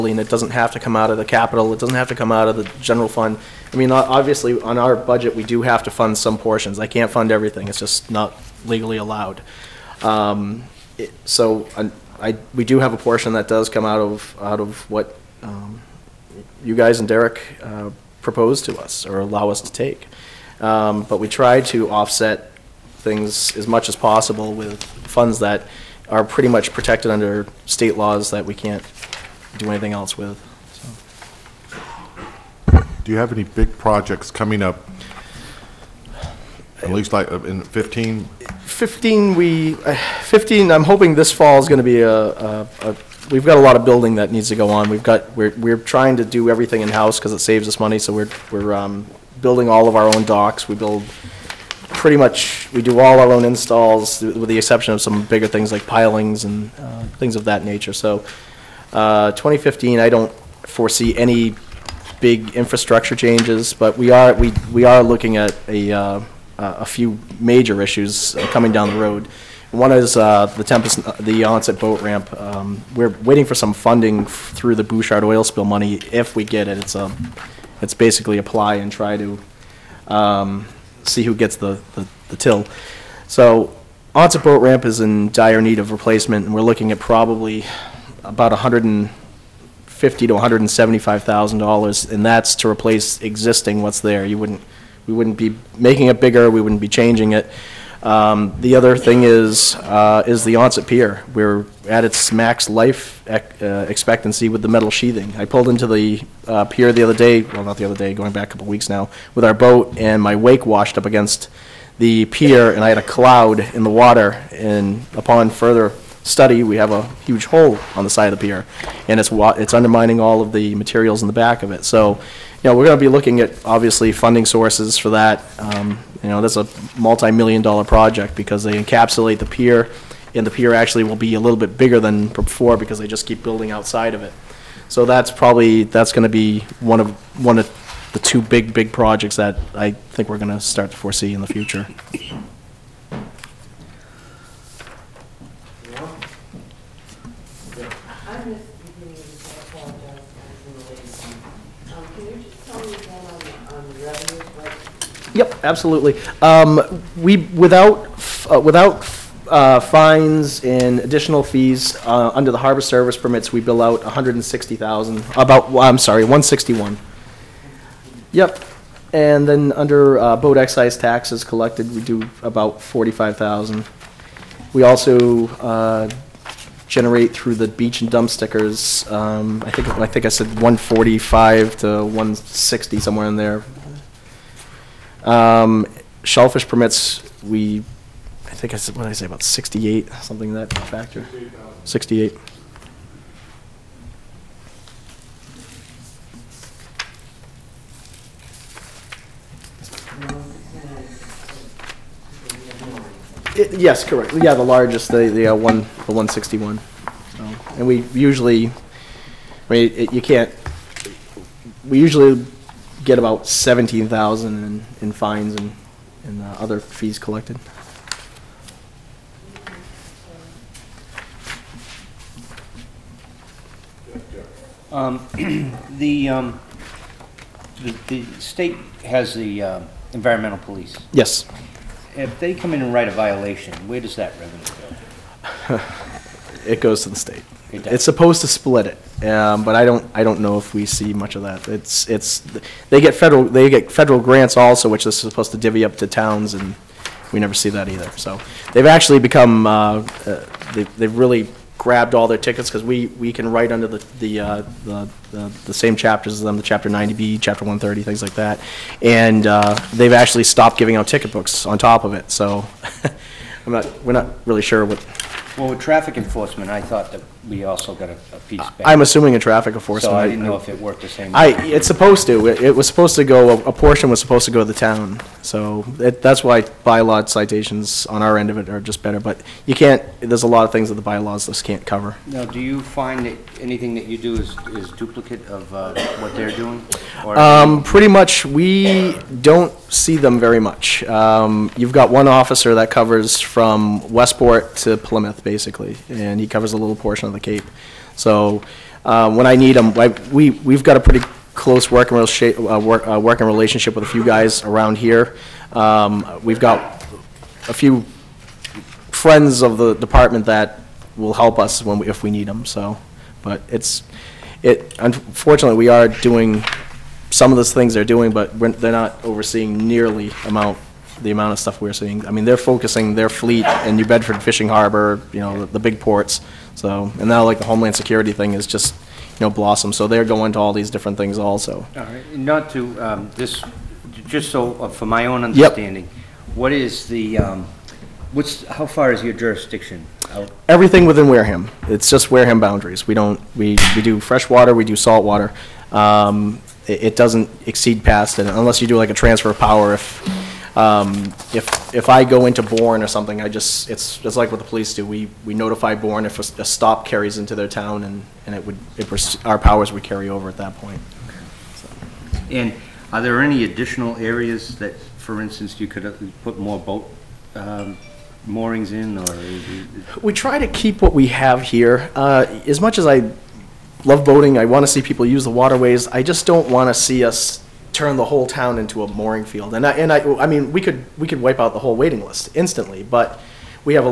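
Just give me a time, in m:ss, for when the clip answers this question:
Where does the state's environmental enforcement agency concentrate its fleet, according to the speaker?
5:23.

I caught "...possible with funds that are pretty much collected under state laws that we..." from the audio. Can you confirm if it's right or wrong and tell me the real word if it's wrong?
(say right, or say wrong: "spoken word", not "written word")
wrong: "protected", not "collected".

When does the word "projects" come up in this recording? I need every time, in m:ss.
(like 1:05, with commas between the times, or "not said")
0:33, 2:07, 2:18.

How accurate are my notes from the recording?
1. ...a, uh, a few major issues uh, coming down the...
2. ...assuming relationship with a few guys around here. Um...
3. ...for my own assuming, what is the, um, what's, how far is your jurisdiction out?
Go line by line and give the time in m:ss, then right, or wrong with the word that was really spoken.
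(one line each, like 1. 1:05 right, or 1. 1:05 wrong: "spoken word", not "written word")
1. 1:05 right
2. 5:03 wrong: "working", not "assuming"
3. 5:34 wrong: "understanding", not "assuming".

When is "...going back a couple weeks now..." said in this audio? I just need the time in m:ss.
1:48.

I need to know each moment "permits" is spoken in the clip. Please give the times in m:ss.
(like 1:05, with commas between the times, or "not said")
2:43, 3:06.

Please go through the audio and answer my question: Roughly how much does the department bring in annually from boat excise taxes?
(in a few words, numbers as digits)
$45,000.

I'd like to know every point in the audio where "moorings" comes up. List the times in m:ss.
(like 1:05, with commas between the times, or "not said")
6:08, 6:19.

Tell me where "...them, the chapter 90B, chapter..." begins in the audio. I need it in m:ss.
4:16.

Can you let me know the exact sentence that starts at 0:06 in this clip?
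I can't fund everything, it's just not legally allowed.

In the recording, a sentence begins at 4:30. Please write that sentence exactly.
So I didn't know if it worked the same.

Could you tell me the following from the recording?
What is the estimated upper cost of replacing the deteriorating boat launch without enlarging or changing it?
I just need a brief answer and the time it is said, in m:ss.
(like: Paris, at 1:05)
$175,000, at 1:30.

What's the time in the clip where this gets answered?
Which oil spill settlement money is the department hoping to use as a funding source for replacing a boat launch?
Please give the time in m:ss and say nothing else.
1:14.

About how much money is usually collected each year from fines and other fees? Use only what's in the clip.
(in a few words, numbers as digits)
$17,000.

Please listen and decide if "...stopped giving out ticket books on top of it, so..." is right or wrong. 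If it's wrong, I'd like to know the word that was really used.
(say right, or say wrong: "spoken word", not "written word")
right.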